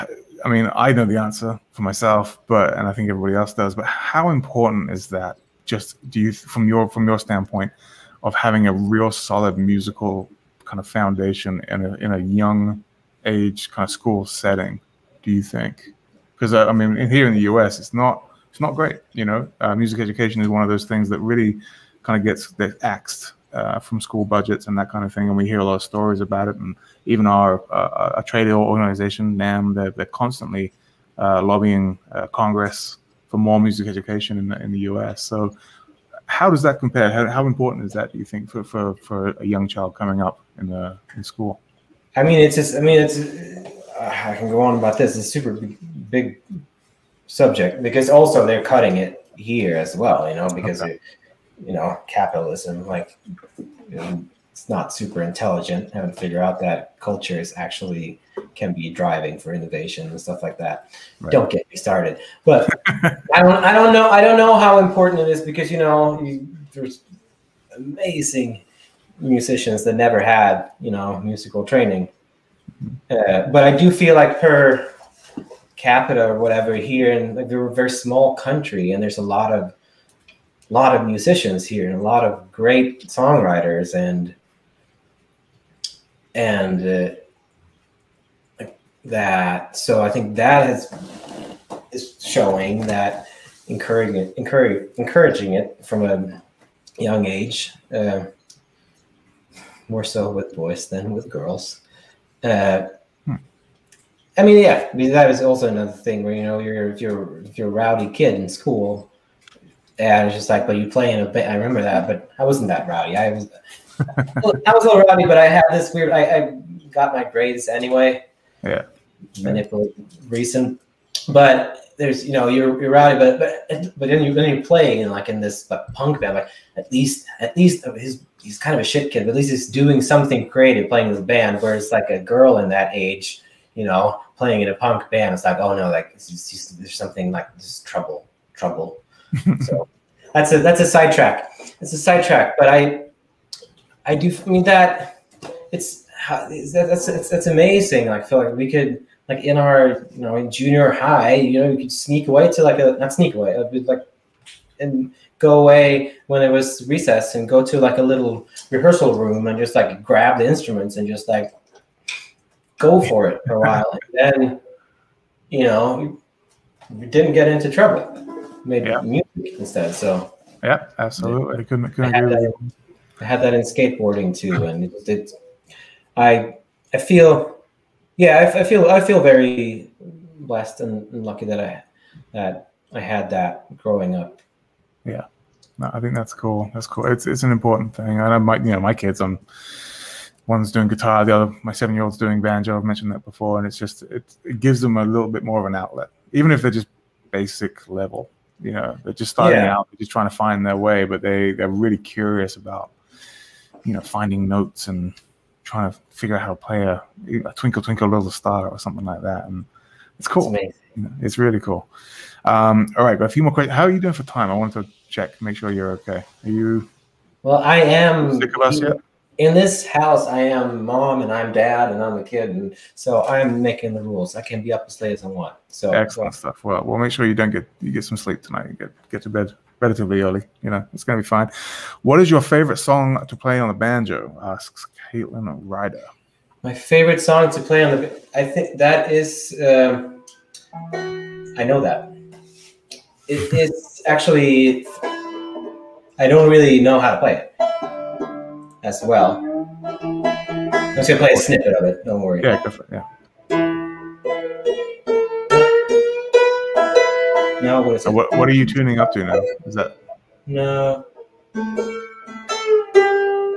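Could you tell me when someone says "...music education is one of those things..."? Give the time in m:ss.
0:19.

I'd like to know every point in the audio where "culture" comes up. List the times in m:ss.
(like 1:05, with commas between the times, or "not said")
0:56.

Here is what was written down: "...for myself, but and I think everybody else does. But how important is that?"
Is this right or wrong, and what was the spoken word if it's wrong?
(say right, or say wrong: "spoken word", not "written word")
right.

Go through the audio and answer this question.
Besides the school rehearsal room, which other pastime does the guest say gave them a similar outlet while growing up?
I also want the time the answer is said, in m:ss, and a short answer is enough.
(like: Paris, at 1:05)
Skateboarding, at 2:53.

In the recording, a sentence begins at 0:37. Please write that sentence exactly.
How, how, important is that, do you think, for, for, for a young child coming up in, the, in school?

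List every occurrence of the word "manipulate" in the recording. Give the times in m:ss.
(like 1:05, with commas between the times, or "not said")
1:59.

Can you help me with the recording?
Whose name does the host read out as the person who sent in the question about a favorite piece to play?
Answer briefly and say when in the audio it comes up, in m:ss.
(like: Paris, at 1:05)
Caitlin Ryder, at 3:55.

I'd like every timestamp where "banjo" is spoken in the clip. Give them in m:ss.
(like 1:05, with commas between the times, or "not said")
3:12, 3:53.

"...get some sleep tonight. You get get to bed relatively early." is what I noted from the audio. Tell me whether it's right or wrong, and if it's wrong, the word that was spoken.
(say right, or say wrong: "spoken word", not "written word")
right.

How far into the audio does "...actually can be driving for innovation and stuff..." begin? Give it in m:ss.
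0:57.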